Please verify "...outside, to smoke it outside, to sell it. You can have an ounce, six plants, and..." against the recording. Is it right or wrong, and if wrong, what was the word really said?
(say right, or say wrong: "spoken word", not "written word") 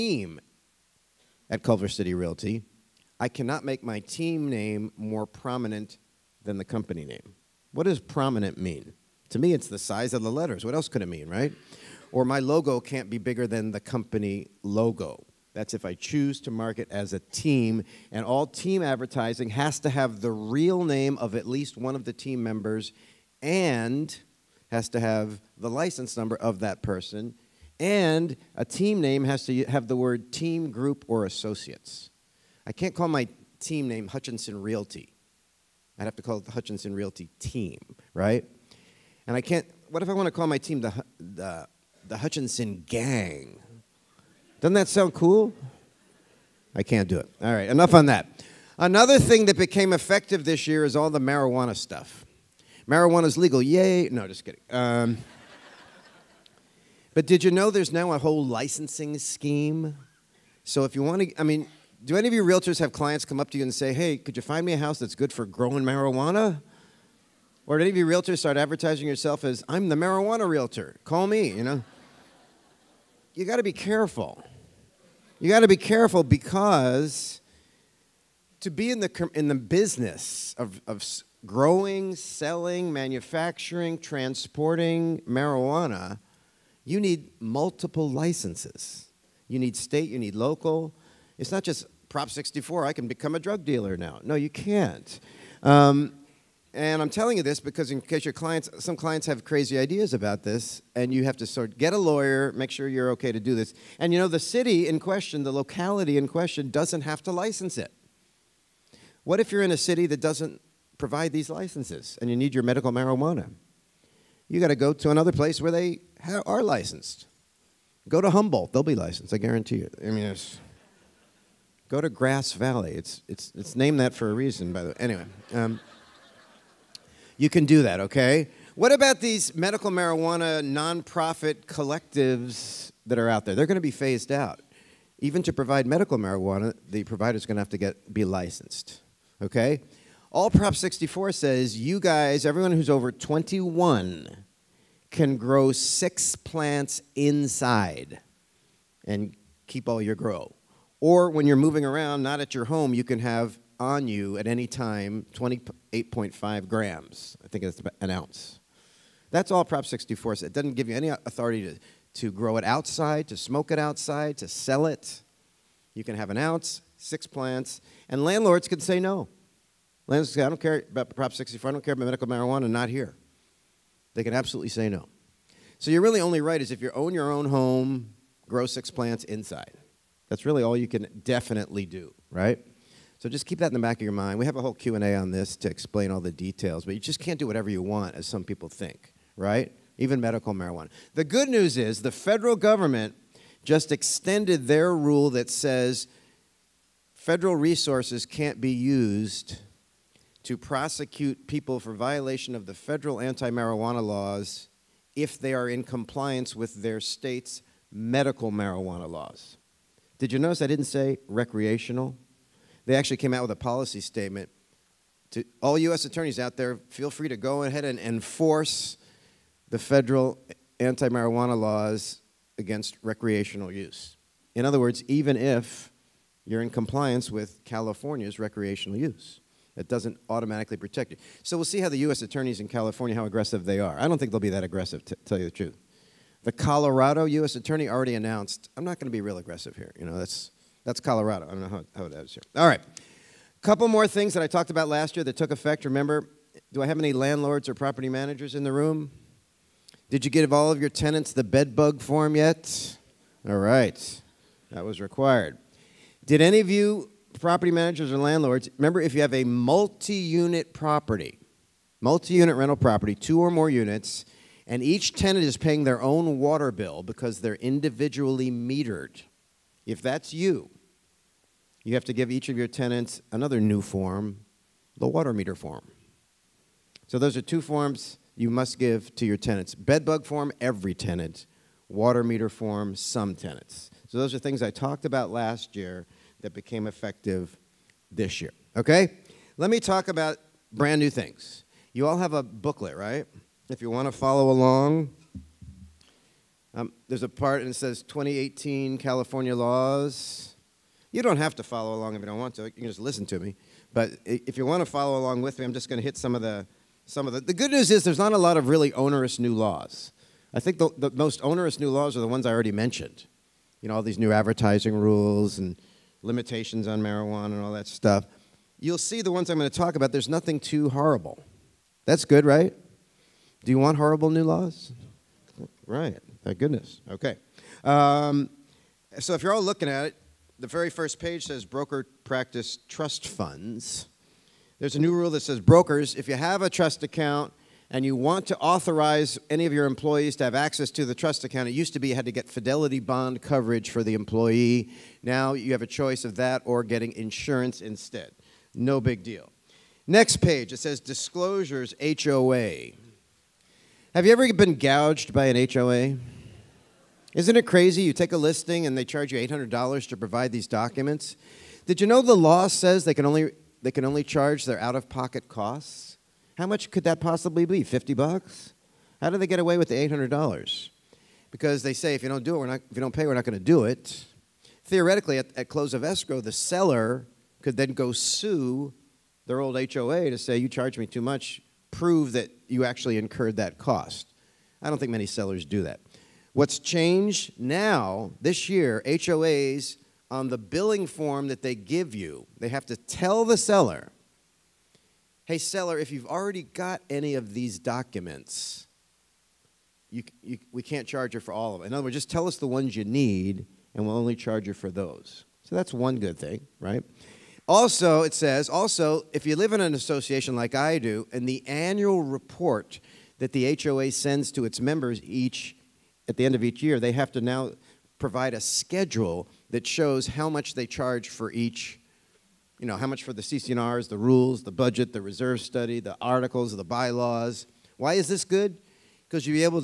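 right.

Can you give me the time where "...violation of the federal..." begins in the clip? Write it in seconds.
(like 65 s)
201 s.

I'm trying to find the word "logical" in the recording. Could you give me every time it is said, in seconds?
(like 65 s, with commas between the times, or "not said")
not said.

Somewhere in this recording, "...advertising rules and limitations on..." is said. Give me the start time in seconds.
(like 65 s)
314 s.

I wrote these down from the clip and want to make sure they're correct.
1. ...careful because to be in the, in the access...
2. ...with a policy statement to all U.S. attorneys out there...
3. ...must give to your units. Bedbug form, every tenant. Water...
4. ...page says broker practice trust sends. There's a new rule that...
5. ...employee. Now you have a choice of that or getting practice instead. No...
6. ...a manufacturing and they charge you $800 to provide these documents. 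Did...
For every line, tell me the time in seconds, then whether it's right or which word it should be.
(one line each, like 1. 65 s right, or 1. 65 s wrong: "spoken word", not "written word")
1. 75 s wrong: "business", not "access"
2. 213 s right
3. 278 s wrong: "tenants", not "units"
4. 331 s wrong: "funds", not "sends"
5. 344 s wrong: "insurance", not "practice"
6. 358 s wrong: "listing", not "manufacturing".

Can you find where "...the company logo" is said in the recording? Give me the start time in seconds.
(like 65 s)
13 s.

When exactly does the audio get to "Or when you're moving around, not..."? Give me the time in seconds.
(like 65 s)
150 s.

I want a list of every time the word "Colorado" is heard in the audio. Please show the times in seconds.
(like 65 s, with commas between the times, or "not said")
236 s, 240 s.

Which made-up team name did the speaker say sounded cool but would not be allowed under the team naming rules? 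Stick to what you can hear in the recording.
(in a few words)
Hutchinson Gang.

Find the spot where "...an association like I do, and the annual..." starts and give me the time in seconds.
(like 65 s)
409 s.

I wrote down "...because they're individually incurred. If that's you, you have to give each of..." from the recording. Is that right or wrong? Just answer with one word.
wrong.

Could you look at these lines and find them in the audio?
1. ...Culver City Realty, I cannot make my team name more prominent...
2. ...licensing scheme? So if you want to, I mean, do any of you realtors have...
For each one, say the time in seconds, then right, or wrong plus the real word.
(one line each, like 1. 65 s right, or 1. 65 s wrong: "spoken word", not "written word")
1. 1 s right
2. 58 s right.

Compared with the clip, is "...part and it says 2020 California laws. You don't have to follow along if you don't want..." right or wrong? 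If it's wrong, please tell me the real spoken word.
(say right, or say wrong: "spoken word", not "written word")
wrong: "2018", not "2020".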